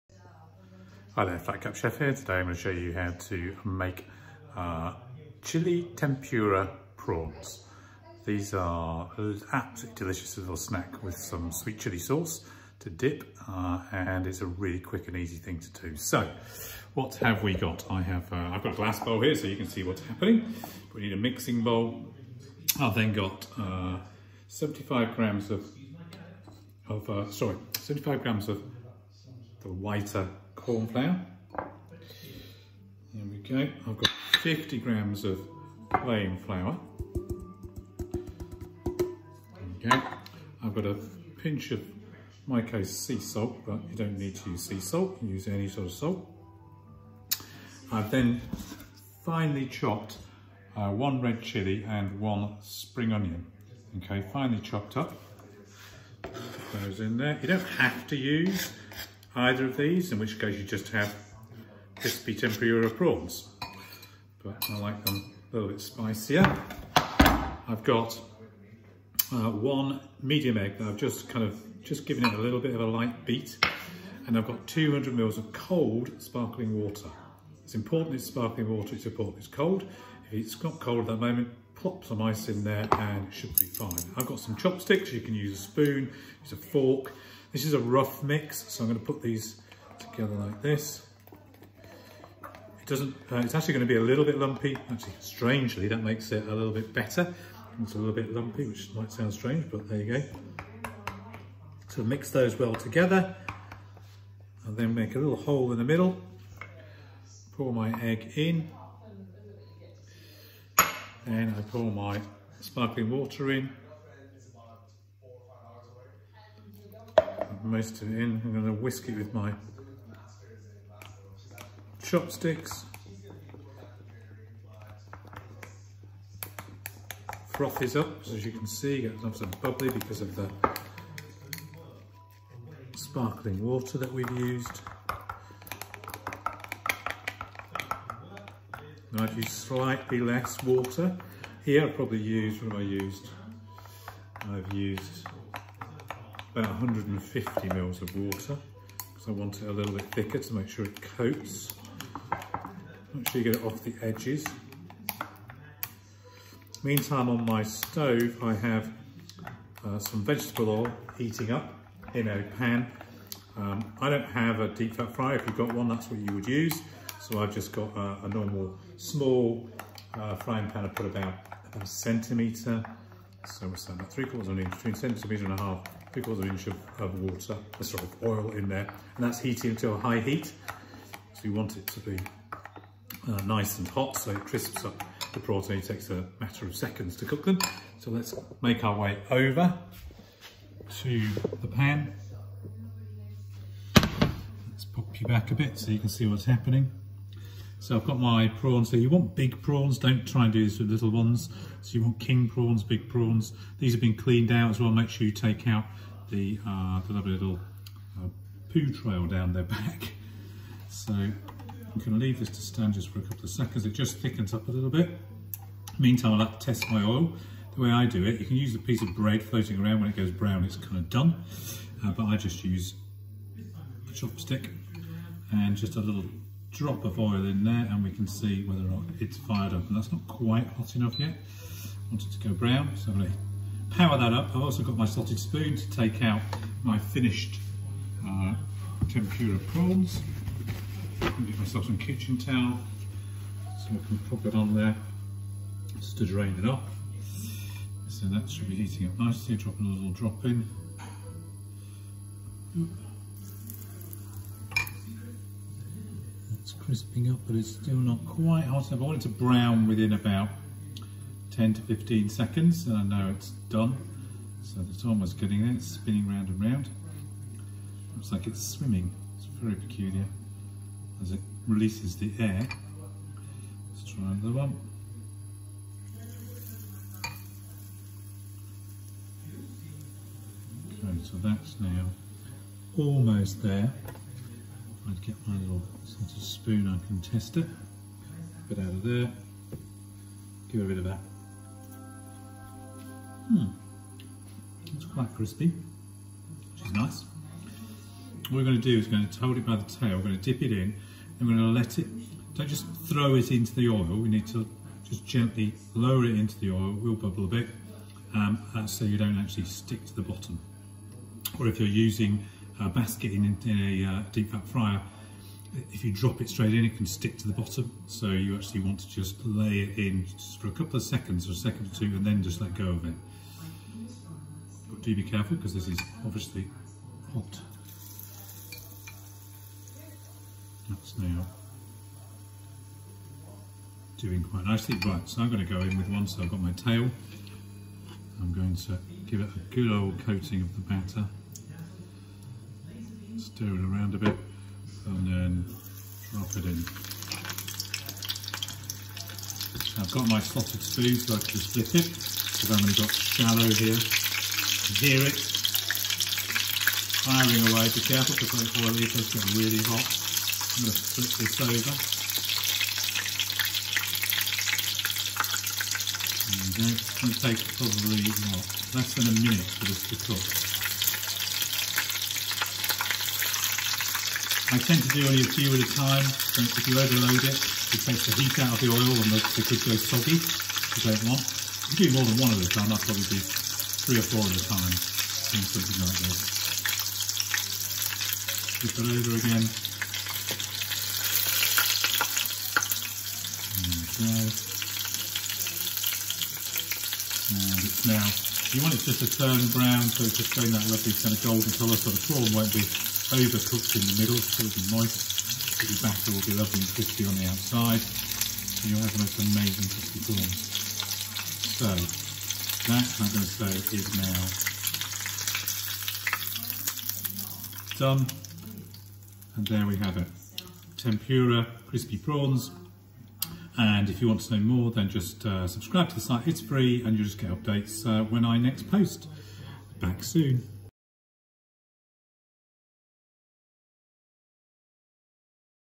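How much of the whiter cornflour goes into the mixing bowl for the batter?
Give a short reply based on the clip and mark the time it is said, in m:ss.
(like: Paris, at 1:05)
75 grams, at 0:27.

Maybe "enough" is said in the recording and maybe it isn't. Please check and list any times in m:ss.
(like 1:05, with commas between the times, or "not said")
3:50, 4:18.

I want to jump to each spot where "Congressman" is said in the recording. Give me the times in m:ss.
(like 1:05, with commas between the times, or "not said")
not said.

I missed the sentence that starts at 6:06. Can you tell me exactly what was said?
It's going to take probably what, less than a minute for this to cook.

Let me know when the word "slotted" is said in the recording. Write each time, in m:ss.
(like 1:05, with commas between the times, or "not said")
3:55, 5:50.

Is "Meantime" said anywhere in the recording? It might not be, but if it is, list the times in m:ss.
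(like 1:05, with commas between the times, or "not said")
2:36, 3:35.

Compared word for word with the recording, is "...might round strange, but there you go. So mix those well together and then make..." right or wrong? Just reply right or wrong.
wrong.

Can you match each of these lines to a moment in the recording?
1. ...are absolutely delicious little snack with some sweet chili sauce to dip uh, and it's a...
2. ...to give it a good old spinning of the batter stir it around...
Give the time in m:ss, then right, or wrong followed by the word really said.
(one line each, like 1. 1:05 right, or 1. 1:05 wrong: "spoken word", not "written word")
1. 0:08 right
2. 5:38 wrong: "coating", not "spinning".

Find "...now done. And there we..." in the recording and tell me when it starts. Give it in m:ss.
6:57.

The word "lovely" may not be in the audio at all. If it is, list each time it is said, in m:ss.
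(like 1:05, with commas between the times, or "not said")
3:27, 6:40, 6:46.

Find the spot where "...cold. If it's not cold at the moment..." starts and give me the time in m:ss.
1:19.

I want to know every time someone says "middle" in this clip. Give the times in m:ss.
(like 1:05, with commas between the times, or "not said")
1:45, 6:44.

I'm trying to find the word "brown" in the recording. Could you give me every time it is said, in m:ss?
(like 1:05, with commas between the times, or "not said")
3:40, 3:52, 4:19, 6:39.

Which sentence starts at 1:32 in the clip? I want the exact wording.
It doesn't, uh, it's actually going to be a little bit lumpy.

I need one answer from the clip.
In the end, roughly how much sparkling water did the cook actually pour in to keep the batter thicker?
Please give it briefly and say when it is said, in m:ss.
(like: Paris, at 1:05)
150 ml, at 2:26.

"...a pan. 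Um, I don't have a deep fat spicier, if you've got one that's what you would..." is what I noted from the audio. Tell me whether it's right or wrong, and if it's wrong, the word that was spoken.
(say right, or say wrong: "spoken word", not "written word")
wrong: "fryer", not "spicier".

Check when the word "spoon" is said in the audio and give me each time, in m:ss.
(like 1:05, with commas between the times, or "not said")
1:25, 3:55, 4:46, 5:50.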